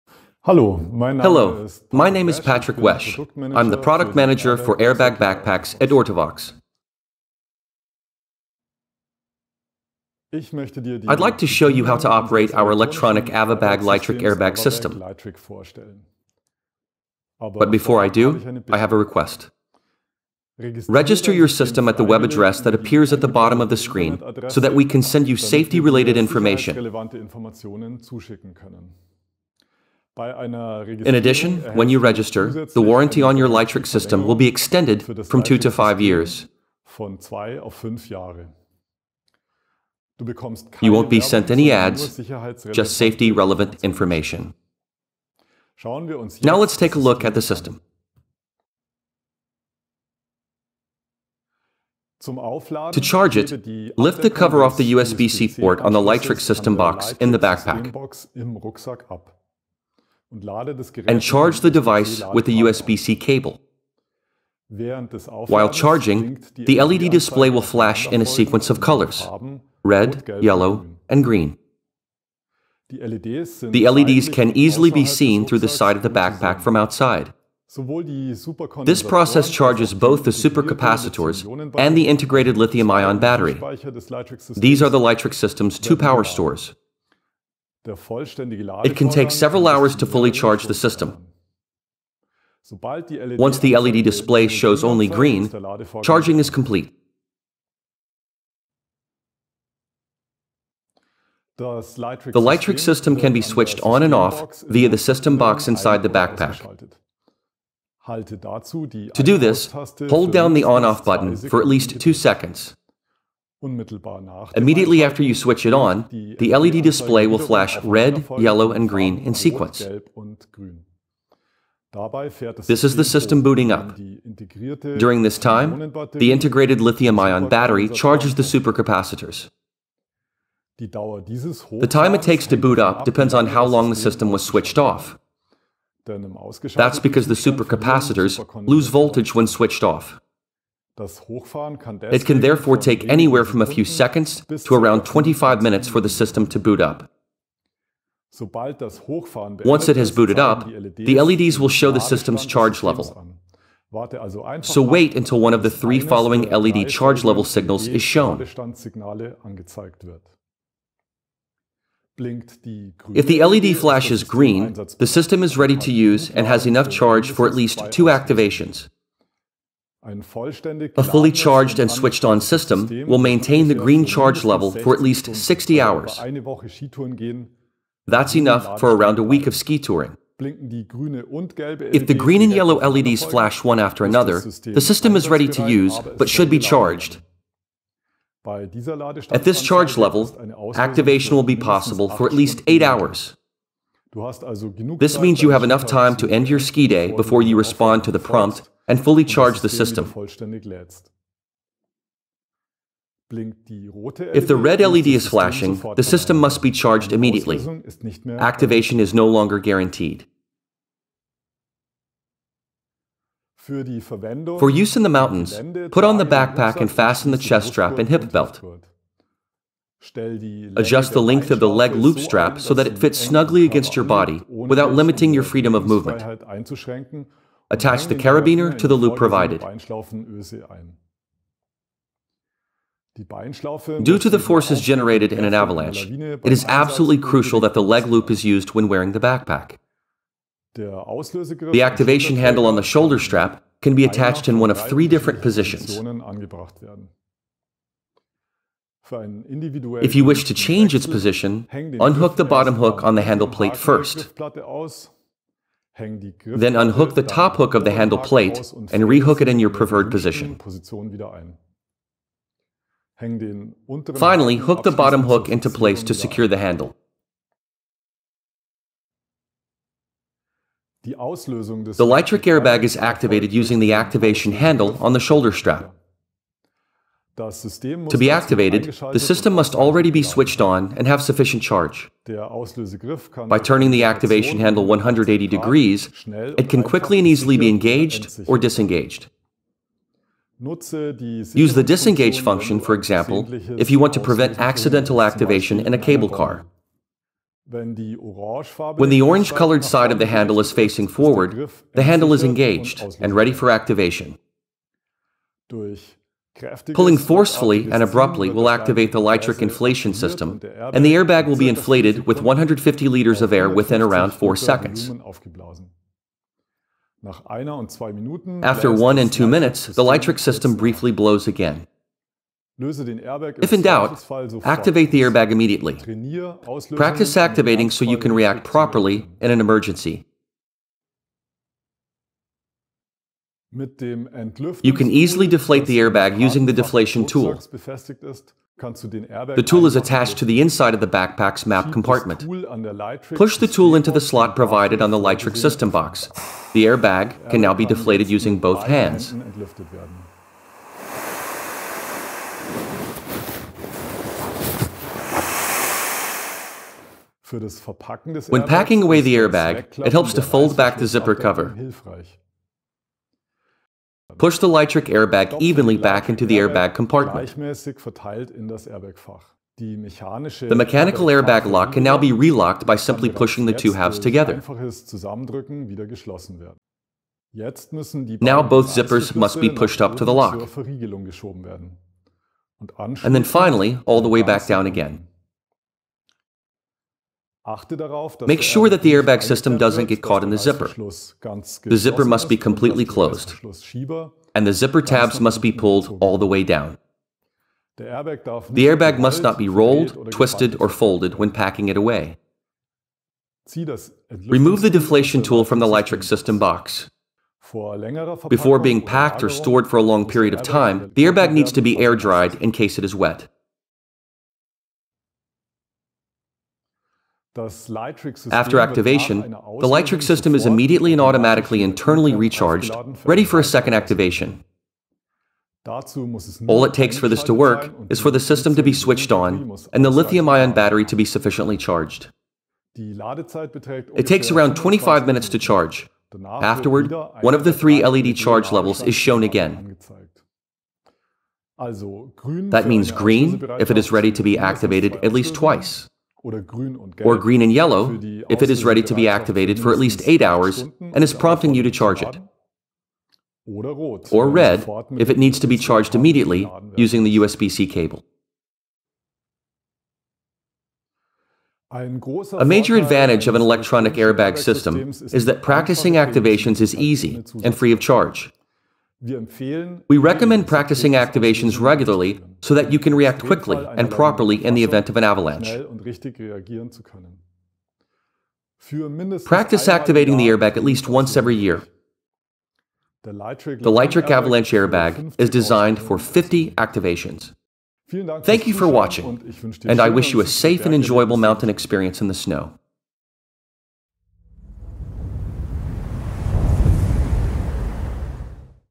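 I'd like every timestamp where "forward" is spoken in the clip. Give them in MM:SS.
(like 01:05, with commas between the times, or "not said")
05:01.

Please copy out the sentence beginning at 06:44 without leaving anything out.
Remove the deflation tool from the LiTRIC system box.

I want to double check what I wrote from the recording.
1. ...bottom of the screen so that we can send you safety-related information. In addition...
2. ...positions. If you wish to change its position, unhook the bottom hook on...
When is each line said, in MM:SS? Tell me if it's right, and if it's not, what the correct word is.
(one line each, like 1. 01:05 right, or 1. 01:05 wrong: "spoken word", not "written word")
1. 00:23 right
2. 04:05 right.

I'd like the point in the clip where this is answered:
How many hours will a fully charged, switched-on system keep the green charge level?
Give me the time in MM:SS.
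02:55.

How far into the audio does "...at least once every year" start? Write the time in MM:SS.
08:00.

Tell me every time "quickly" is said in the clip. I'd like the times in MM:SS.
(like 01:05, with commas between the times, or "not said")
04:46, 07:53.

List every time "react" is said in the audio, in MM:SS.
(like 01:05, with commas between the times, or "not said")
05:28, 07:53.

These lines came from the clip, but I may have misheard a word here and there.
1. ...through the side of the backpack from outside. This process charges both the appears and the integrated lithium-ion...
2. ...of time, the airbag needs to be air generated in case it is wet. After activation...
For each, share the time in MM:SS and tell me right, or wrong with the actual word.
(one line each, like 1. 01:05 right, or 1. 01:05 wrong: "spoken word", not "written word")
1. 01:15 wrong: "supercapacitors", not "appears"
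2. 06:50 wrong: "dried", not "generated".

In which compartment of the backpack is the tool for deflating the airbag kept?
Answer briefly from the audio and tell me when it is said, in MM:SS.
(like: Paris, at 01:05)
Map compartment, at 05:41.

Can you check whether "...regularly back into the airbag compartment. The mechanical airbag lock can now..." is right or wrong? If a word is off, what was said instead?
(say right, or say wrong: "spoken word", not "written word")
wrong: "evenly", not "regularly".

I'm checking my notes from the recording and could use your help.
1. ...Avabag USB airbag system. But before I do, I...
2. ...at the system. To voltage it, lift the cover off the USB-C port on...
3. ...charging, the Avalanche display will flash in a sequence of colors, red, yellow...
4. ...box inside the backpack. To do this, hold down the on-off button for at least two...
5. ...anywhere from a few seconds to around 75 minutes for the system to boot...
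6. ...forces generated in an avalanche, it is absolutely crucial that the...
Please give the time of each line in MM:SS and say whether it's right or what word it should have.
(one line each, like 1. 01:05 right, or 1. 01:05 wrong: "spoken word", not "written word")
1. 00:13 wrong: "LiTRIC", not "USB"
2. 00:47 wrong: "charge", not "voltage"
3. 01:05 wrong: "LED", not "Avalanche"
4. 01:45 right
5. 02:23 wrong: "25", not "75"
6. 03:54 right.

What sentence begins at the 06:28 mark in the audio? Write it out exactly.
Make er sure that the airbag system doesn't get caught in the zipper.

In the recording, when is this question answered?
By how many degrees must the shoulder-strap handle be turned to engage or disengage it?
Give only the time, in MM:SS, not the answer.
04:44.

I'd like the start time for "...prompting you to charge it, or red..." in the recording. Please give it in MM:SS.
07:31.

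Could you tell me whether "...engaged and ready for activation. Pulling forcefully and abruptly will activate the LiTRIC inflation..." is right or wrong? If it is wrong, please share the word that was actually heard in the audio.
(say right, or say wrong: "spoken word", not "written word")
right.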